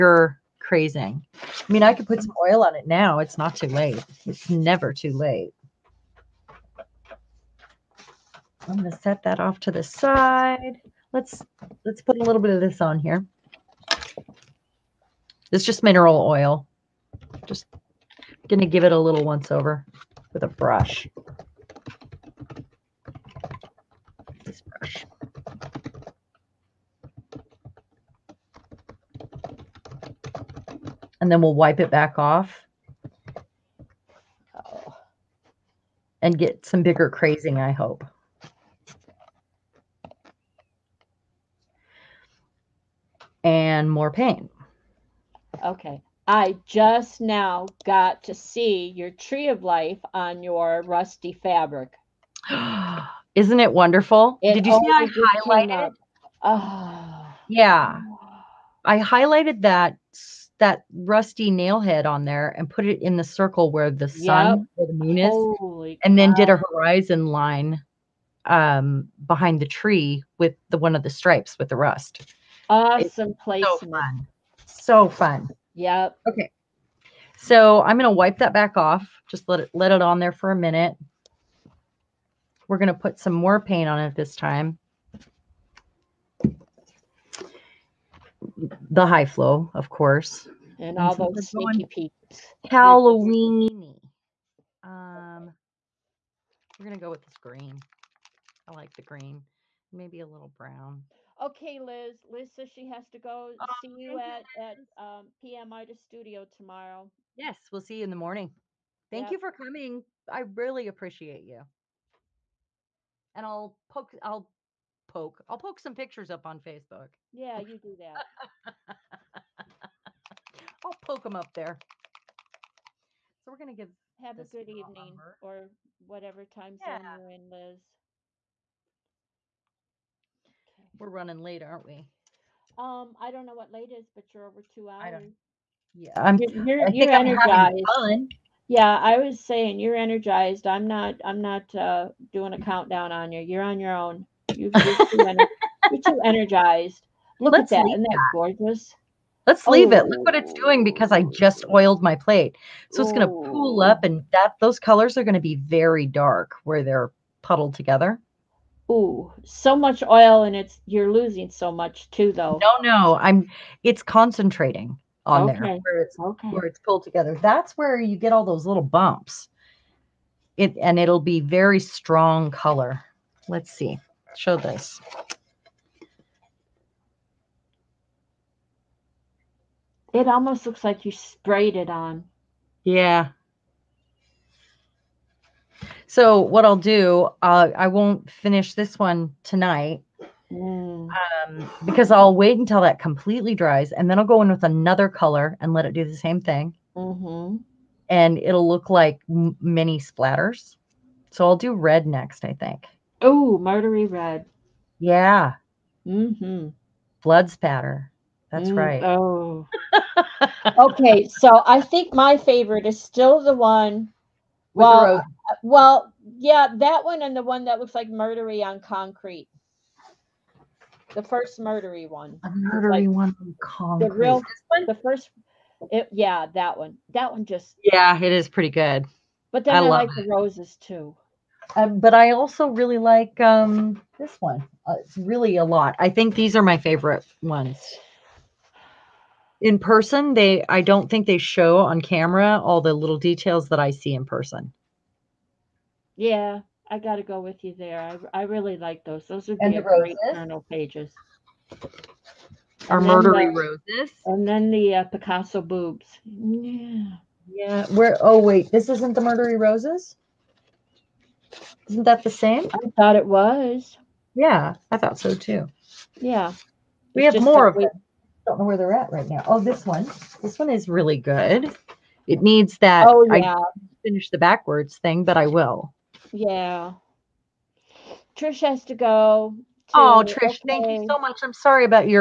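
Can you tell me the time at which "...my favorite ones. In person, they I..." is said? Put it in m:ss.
3:56.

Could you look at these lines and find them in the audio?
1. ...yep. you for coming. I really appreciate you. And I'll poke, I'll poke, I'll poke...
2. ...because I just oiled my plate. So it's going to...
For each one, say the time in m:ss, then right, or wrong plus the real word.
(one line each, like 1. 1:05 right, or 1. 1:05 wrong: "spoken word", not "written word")
1. 1:49 right
2. 2:30 right.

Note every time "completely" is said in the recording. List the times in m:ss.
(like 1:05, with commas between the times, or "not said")
3:12.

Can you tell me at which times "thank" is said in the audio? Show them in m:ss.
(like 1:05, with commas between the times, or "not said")
1:49, 4:40.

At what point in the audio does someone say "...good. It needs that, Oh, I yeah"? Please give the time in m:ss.
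4:31.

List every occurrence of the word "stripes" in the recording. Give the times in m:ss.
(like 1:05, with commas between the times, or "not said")
1:11.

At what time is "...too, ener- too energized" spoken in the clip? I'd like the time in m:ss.
2:24.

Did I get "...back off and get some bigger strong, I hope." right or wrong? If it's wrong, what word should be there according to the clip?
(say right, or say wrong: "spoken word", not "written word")
wrong: "crazing", not "strong".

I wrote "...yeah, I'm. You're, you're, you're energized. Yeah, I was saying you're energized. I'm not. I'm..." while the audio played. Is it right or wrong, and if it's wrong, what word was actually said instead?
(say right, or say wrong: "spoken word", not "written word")
right.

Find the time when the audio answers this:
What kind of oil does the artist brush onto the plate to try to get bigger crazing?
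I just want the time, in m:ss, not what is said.
0:15.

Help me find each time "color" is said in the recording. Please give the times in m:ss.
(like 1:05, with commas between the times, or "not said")
2:34, 2:52, 3:15.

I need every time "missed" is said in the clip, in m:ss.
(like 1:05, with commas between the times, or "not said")
not said.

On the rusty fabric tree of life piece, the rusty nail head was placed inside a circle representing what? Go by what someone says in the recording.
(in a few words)
The moon.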